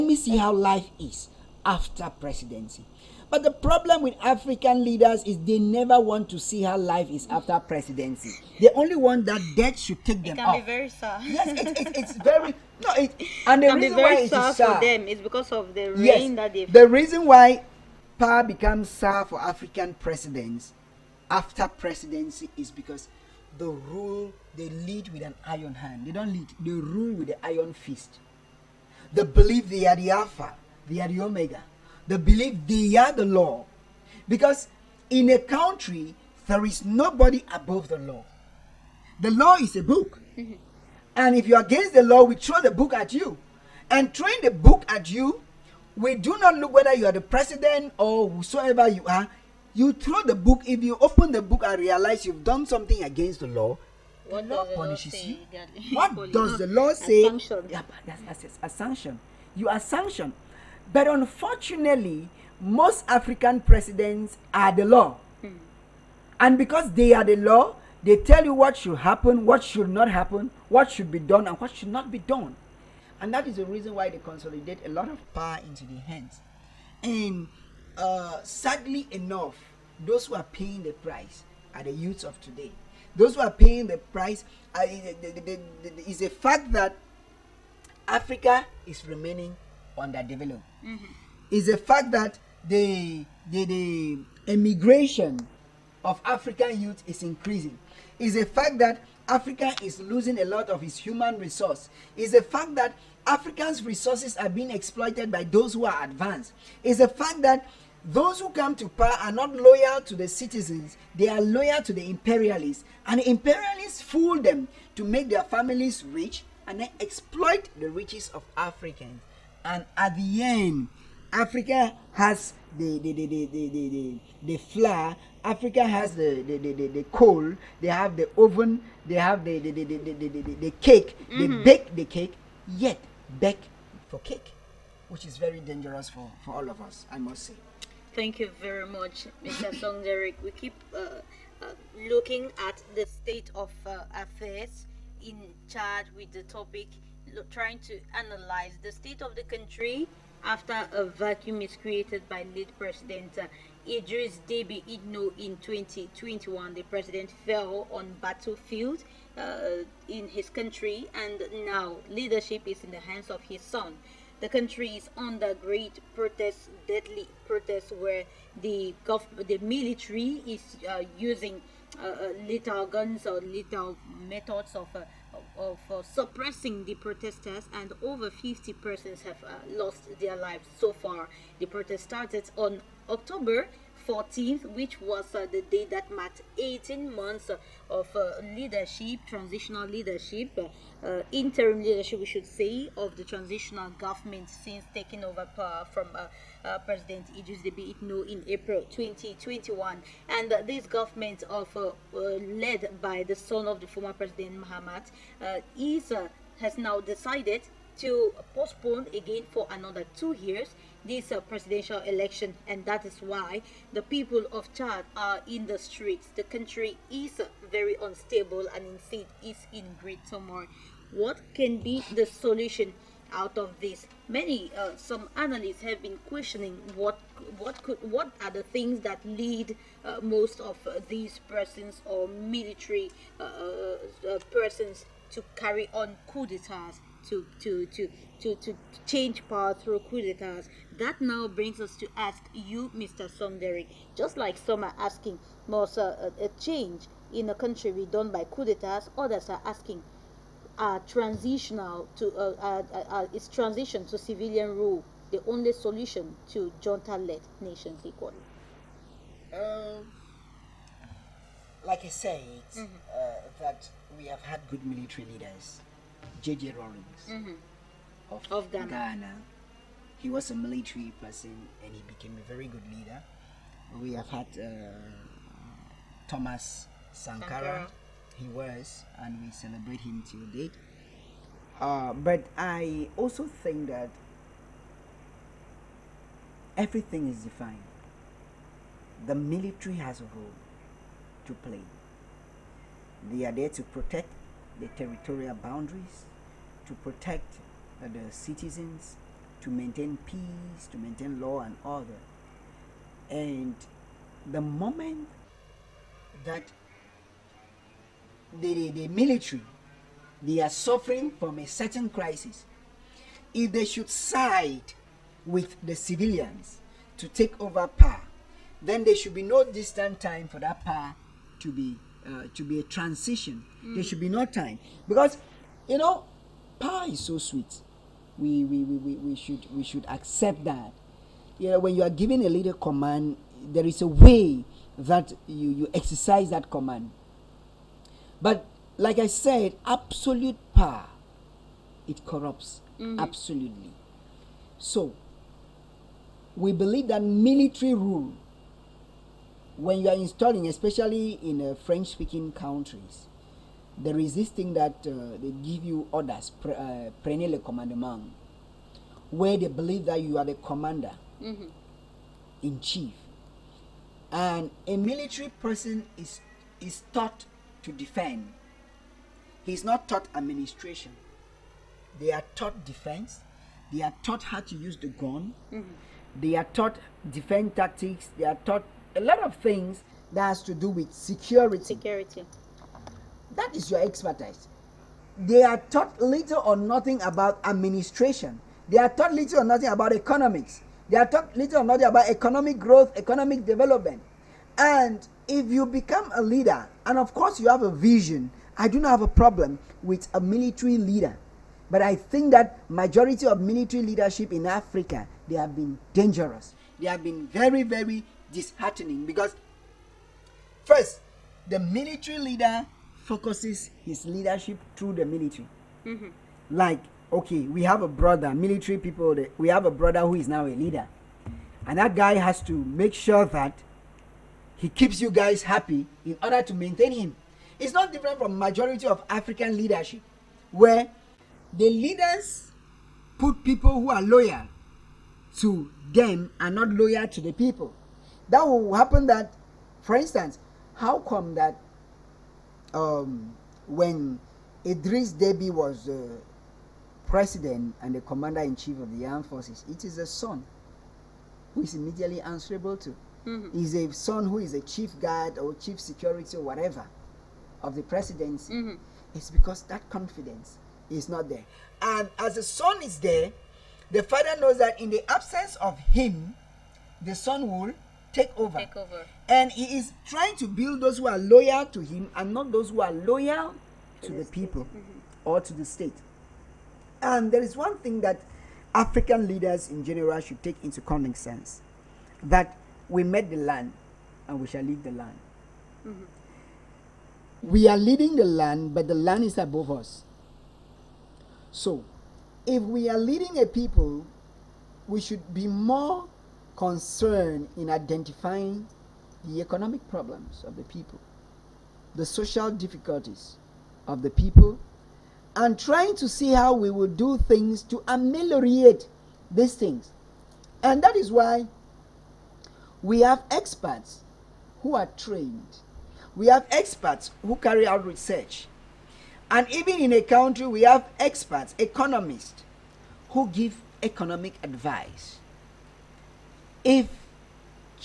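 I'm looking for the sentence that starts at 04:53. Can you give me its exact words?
They are there to protect the territorial boundaries, to protect uh, the citizens, to maintain peace, to maintain law and order.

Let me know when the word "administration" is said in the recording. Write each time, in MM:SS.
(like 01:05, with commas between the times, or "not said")
06:10, 06:27.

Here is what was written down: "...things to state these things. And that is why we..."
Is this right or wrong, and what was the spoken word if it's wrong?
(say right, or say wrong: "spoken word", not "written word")
wrong: "ameliorate", not "state".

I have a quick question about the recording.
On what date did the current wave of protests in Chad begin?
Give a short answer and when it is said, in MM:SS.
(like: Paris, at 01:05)
October 14, at 03:03.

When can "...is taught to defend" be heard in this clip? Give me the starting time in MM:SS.
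06:06.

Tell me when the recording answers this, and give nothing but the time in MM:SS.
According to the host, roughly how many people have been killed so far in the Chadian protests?
02:58.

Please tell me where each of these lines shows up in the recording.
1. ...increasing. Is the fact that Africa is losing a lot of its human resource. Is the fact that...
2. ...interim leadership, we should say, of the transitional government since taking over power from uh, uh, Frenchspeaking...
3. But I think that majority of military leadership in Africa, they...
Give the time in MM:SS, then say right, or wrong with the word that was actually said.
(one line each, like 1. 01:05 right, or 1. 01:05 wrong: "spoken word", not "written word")
1. 01:37 right
2. 03:11 wrong: "President", not "Frenchspeaking"
3. 06:41 right.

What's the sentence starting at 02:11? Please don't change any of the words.
they bake the cake, yet bake for cake, which is very dangerous for, for all of us, I must say.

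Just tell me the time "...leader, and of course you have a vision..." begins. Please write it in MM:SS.
06:36.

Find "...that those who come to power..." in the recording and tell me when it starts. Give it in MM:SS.
01:47.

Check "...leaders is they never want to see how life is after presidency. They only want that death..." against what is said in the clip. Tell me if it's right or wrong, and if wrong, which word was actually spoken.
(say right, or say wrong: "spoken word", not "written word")
right.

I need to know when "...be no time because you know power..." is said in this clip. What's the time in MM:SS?
05:24.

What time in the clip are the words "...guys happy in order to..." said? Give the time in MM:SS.
07:05.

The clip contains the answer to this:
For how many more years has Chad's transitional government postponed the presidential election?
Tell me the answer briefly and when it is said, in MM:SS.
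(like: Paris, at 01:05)
2 years, at 03:29.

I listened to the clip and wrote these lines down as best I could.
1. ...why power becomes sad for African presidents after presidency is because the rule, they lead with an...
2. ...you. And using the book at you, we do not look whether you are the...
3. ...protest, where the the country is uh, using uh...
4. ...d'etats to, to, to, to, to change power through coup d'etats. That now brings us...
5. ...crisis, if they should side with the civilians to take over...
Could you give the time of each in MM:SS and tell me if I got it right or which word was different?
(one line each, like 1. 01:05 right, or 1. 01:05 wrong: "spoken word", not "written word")
1. 00:17 right
2. 00:43 wrong: "throwing", not "using"
3. 02:47 wrong: "military", not "country"
4. 03:56 right
5. 05:12 right.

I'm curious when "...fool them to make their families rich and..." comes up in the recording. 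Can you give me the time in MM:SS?
01:53.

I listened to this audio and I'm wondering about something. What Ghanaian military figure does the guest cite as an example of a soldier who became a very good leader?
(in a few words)
J.J. Rawlings.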